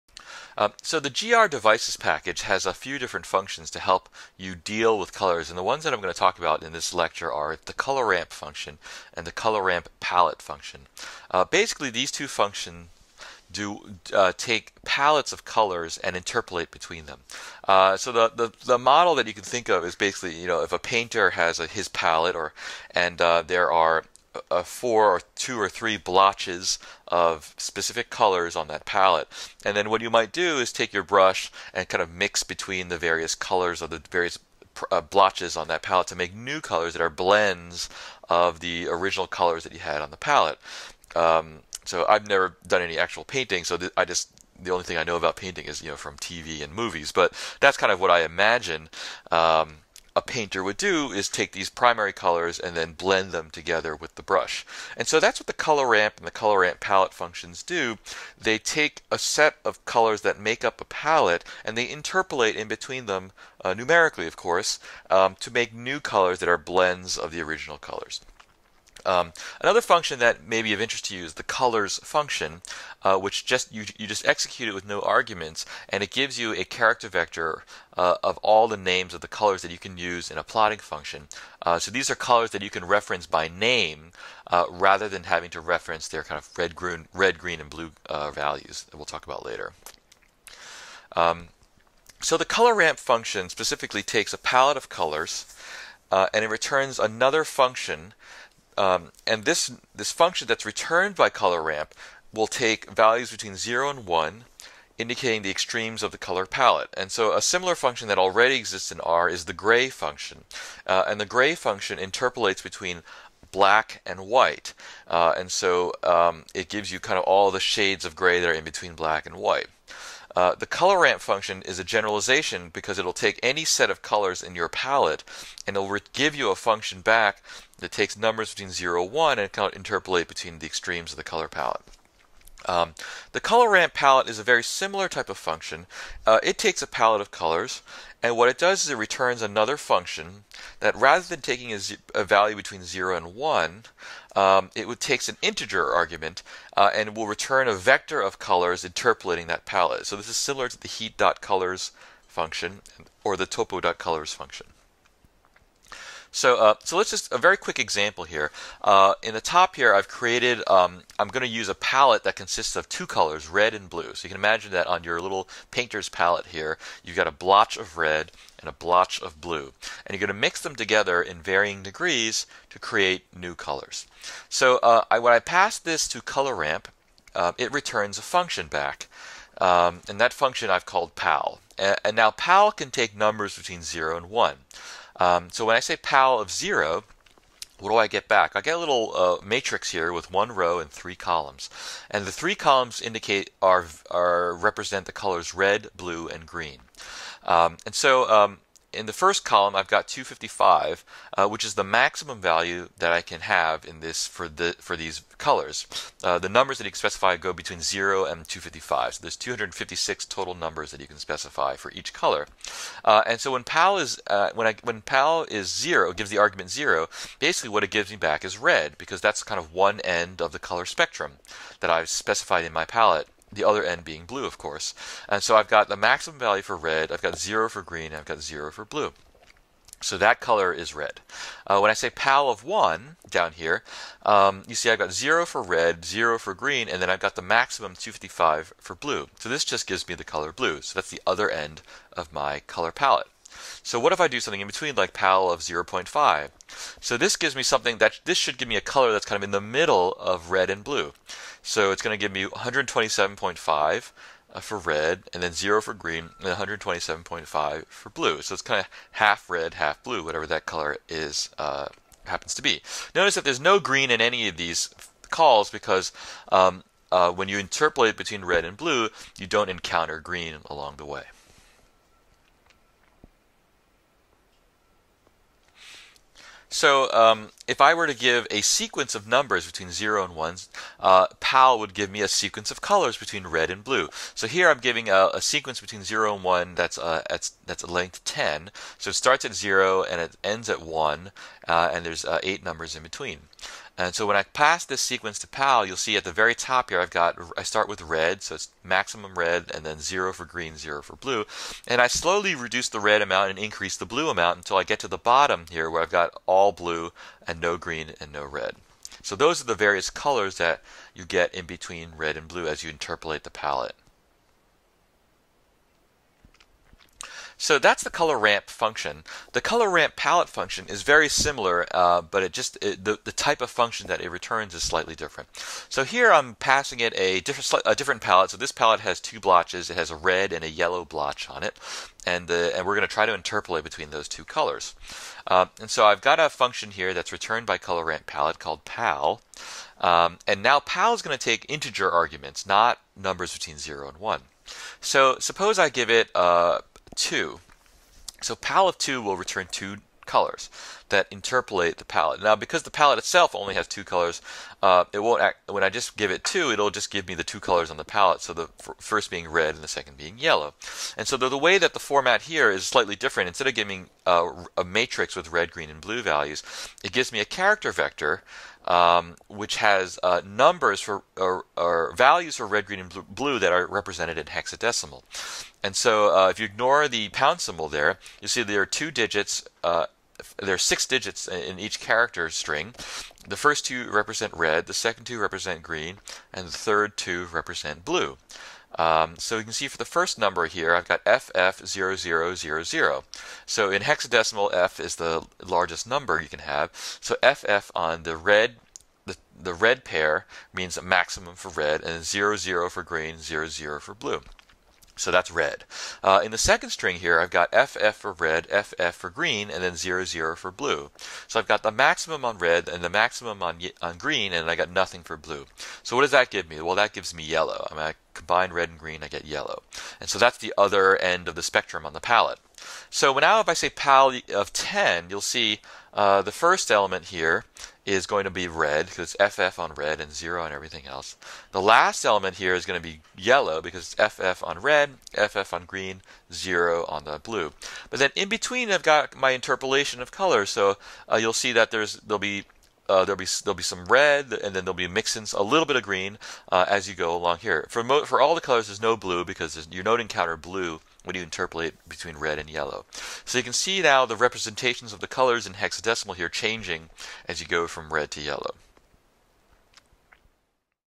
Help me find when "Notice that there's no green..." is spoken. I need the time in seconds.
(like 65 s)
263 s.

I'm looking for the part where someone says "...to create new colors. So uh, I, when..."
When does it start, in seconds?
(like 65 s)
172 s.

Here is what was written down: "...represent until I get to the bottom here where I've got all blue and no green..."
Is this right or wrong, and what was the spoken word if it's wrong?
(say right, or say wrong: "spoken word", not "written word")
wrong: "amount", not "represent".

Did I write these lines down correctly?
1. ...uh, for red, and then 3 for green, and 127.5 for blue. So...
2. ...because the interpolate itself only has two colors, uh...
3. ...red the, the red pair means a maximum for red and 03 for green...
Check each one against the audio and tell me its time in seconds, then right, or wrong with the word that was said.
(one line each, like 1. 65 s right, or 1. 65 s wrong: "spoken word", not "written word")
1. 254 s wrong: "0", not "3"
2. 352 s wrong: "palette", not "interpolate"
3. 398 s wrong: "00", not "03".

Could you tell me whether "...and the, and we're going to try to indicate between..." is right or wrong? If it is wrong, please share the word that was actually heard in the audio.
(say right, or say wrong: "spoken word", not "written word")
wrong: "interpolate", not "indicate".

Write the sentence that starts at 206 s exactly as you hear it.
Uh, the numbers that you can specify go between 0 and 255.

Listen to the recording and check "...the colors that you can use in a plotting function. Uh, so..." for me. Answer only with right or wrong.
right.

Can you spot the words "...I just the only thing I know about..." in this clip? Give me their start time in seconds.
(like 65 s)
43 s.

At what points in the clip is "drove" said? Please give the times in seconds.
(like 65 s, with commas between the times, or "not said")
not said.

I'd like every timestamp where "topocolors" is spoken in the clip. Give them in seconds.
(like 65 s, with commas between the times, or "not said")
153 s.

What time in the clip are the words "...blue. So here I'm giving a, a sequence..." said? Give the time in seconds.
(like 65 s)
283 s.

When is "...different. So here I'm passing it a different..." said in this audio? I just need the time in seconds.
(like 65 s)
325 s.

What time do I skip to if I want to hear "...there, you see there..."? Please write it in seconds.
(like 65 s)
377 s.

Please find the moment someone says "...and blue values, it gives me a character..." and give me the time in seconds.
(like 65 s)
365 s.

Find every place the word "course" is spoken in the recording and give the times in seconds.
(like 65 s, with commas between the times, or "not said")
64 s, 224 s.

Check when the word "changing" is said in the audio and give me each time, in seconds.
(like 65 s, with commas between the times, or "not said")
456 s.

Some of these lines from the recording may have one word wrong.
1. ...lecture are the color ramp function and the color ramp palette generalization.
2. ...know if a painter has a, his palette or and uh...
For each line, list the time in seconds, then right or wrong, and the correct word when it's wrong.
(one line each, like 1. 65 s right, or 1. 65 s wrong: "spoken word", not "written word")
1. 6 s wrong: "function", not "generalization"
2. 20 s right.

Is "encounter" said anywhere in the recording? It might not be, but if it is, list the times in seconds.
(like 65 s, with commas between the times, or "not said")
269 s, 450 s.